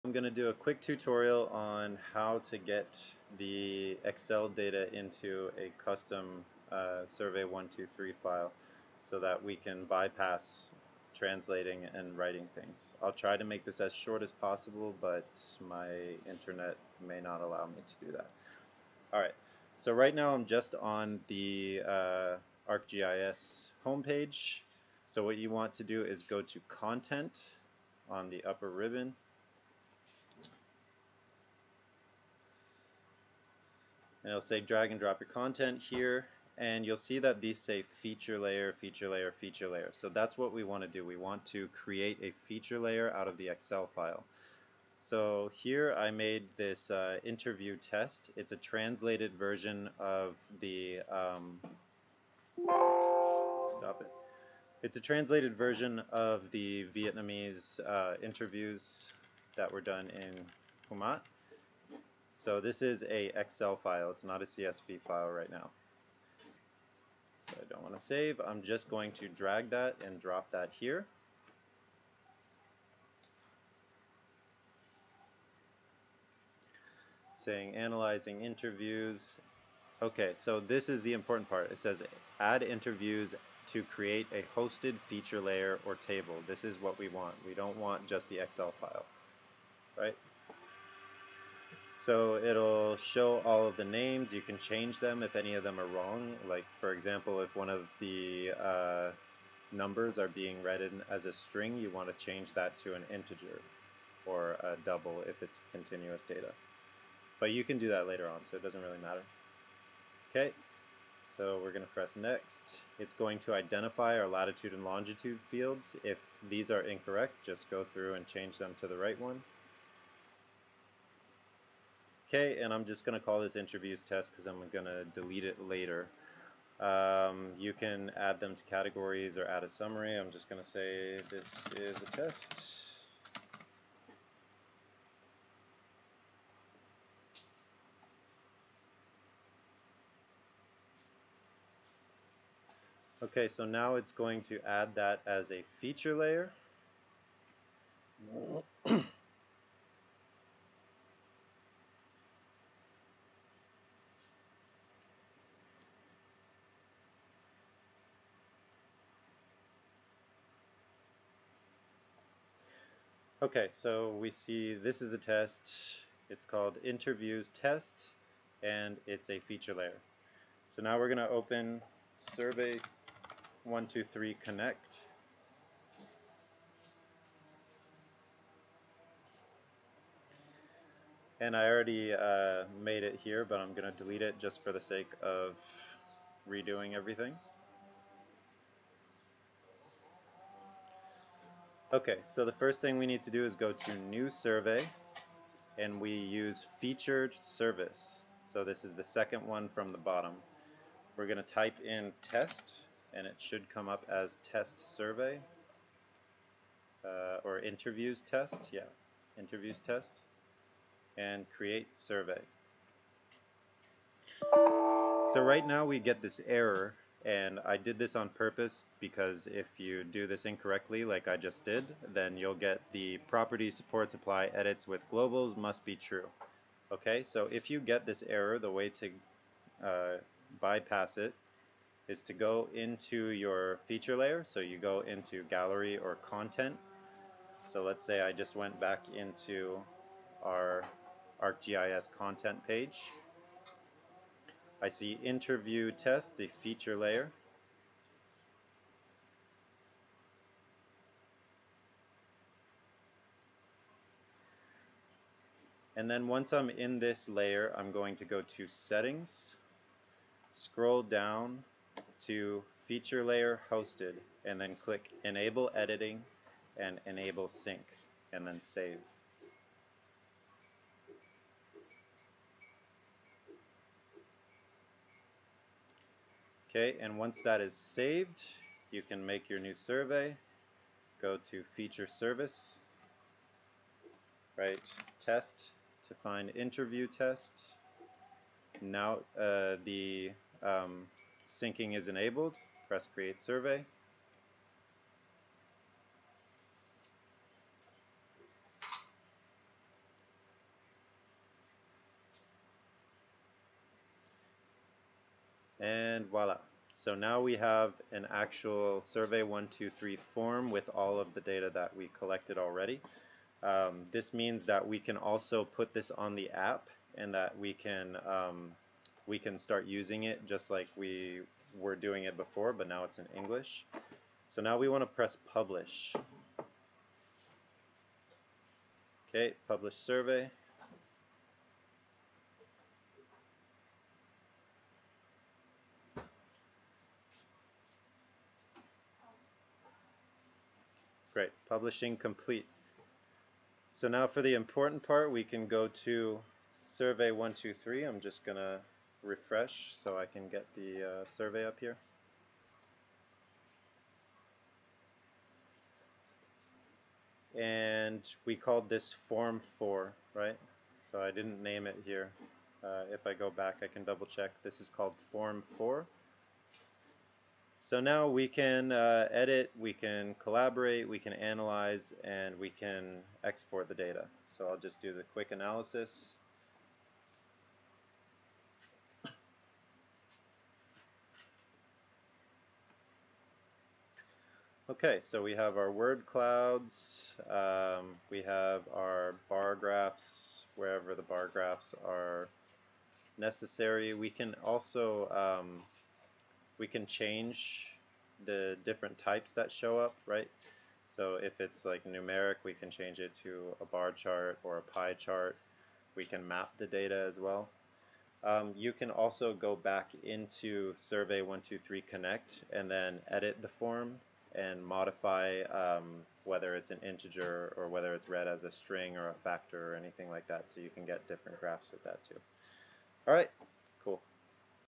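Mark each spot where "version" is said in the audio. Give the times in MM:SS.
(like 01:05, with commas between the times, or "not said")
00:49, 00:55.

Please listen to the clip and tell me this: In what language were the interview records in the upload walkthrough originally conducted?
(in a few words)
Vietnamese.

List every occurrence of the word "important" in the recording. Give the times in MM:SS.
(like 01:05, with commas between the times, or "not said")
01:21, 05:44.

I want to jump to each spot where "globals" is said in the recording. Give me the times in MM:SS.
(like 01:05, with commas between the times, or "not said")
03:45.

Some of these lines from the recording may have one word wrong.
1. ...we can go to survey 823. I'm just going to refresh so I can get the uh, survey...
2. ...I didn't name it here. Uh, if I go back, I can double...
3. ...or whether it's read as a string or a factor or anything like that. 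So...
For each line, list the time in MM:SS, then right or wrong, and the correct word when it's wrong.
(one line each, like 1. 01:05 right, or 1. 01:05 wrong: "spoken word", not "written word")
1. 05:45 wrong: "123", not "823"
2. 06:01 right
3. 06:57 right.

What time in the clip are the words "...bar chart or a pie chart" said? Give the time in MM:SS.
06:43.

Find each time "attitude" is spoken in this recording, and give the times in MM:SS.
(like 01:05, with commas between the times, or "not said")
not said.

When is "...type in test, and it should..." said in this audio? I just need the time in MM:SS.
03:21.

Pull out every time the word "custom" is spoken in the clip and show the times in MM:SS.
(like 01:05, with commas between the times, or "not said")
00:05.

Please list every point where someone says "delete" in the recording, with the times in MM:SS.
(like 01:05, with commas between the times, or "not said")
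02:05, 03:04.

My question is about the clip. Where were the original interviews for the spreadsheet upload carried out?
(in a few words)
Kumat.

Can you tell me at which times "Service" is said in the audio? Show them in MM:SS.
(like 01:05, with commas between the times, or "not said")
03:17, 04:42.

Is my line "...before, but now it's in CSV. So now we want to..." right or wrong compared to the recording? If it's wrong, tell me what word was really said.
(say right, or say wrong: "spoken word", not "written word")
wrong: "English", not "CSV".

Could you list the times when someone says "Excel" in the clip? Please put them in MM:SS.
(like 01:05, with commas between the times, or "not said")
00:04, 00:43, 01:03, 01:28.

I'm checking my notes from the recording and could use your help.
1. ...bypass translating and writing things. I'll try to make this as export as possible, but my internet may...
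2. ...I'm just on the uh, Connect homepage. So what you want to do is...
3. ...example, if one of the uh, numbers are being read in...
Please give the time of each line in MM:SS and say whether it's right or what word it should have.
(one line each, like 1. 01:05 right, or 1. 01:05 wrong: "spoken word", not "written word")
1. 00:09 wrong: "short", not "export"
2. 00:20 wrong: "ArcGIS", not "Connect"
3. 01:36 right.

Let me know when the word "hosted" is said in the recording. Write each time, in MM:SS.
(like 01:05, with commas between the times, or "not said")
01:24, 04:23.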